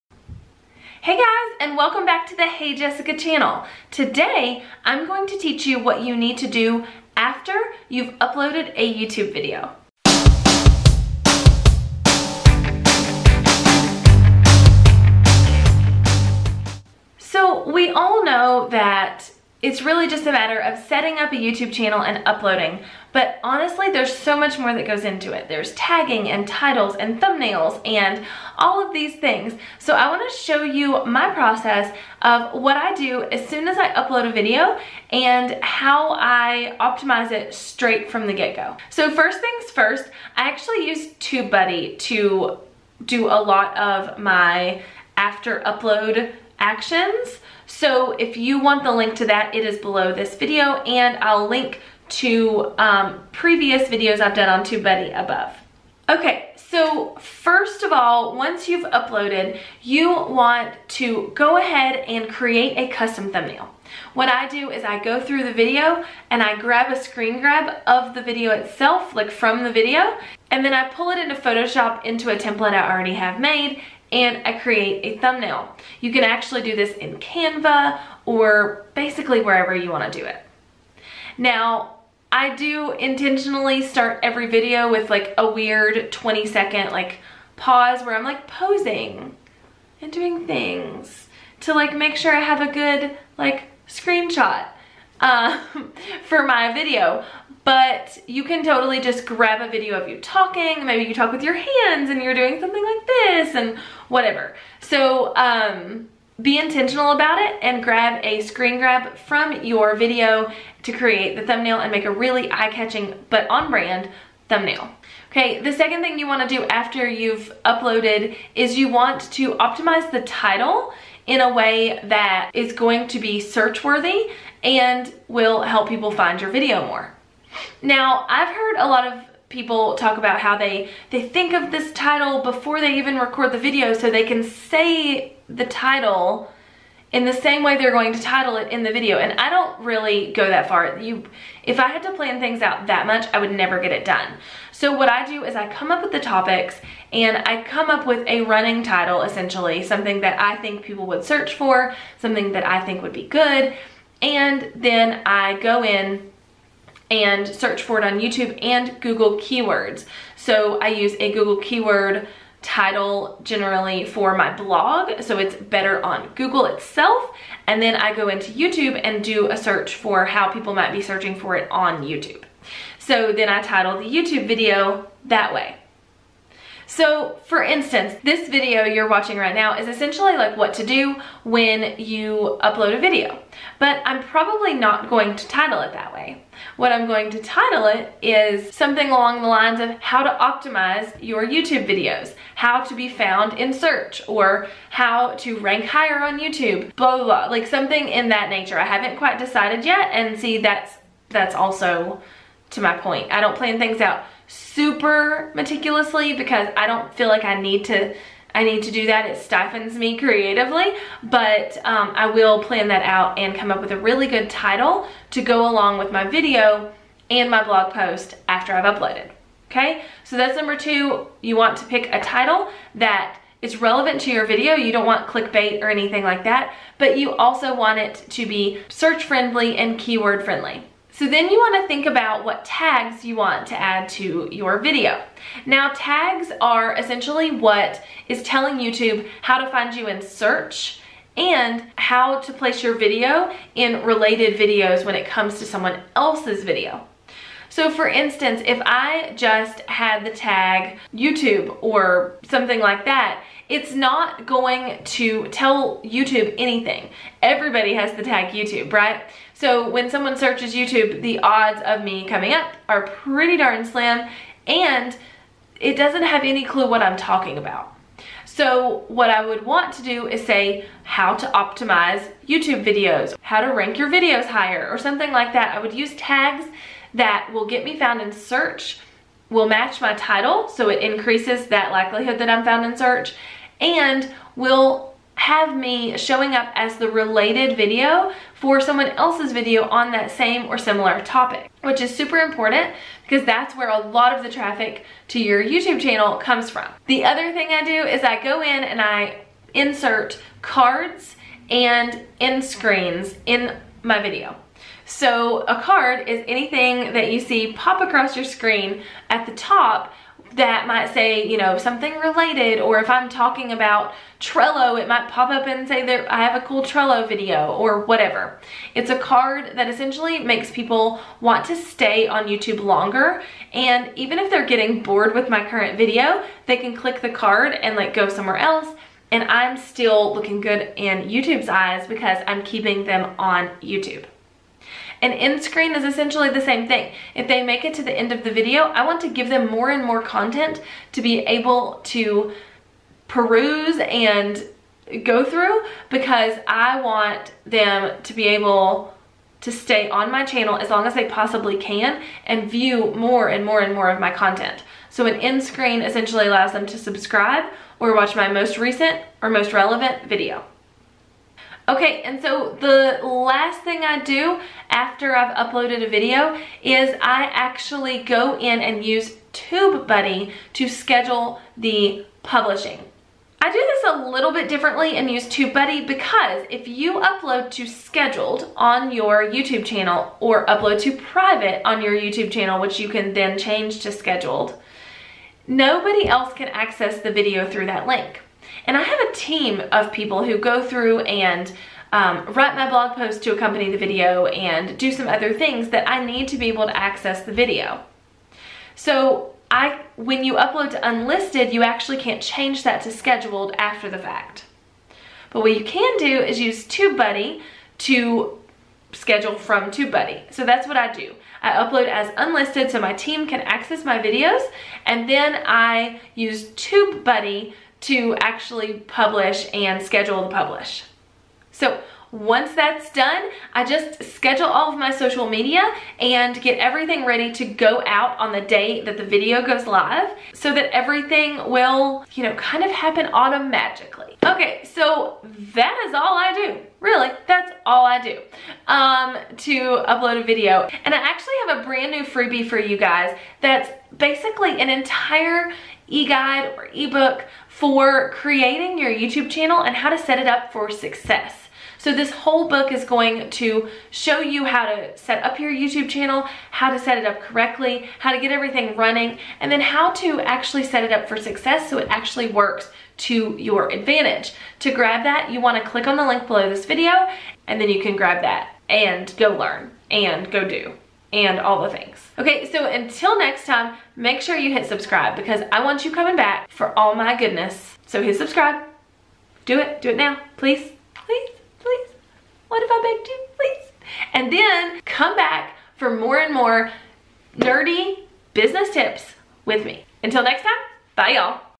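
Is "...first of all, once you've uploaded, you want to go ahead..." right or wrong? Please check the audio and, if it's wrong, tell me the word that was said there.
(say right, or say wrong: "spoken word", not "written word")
right.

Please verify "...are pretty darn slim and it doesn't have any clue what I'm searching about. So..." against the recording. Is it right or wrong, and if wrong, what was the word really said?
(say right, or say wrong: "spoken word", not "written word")
wrong: "talking", not "searching".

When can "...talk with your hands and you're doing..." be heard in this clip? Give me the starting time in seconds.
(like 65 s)
101 s.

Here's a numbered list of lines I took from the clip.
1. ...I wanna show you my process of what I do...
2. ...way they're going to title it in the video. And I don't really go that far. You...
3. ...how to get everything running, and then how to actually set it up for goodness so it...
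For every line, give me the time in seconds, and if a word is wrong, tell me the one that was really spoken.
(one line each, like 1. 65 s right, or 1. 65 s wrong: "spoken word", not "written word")
1. 29 s right
2. 137 s right
3. 458 s wrong: "success", not "goodness".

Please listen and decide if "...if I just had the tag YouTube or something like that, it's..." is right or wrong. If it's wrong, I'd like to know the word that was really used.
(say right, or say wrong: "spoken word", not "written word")
right.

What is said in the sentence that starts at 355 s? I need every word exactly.
So an end screen essentially allows them to subscribe or watch my most recent or most relevant video.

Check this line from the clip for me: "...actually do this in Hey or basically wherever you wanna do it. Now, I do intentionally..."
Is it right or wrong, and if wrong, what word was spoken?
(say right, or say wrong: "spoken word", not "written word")
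wrong: "Canva", not "Hey".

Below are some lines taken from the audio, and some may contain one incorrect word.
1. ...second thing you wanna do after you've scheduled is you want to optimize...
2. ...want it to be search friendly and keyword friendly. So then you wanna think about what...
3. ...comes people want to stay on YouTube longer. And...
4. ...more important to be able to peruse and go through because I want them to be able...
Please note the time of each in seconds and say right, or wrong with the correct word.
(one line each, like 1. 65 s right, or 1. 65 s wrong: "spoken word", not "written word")
1. 115 s wrong: "uploaded", not "scheduled"
2. 227 s right
3. 320 s wrong: "makes", not "comes"
4. 340 s wrong: "content", not "important".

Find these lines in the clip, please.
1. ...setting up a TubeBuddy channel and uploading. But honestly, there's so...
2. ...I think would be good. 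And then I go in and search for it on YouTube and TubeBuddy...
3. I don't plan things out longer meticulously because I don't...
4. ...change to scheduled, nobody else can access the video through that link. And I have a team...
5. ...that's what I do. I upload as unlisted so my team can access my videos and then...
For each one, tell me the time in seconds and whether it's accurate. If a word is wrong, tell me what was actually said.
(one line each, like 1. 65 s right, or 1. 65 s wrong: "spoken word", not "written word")
1. 20 s wrong: "YouTube", not "TubeBuddy"
2. 152 s wrong: "Google", not "TubeBuddy"
3. 203 s wrong: "super", not "longer"
4. 383 s right
5. 410 s right.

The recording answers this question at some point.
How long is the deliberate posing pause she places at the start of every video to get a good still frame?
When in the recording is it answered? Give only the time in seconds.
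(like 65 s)
86 s.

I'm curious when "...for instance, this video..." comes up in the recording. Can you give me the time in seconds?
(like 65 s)
177 s.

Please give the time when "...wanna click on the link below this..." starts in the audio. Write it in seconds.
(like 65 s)
465 s.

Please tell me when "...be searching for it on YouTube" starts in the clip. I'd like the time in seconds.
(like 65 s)
170 s.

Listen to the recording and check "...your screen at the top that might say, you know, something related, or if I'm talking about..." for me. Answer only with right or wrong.
right.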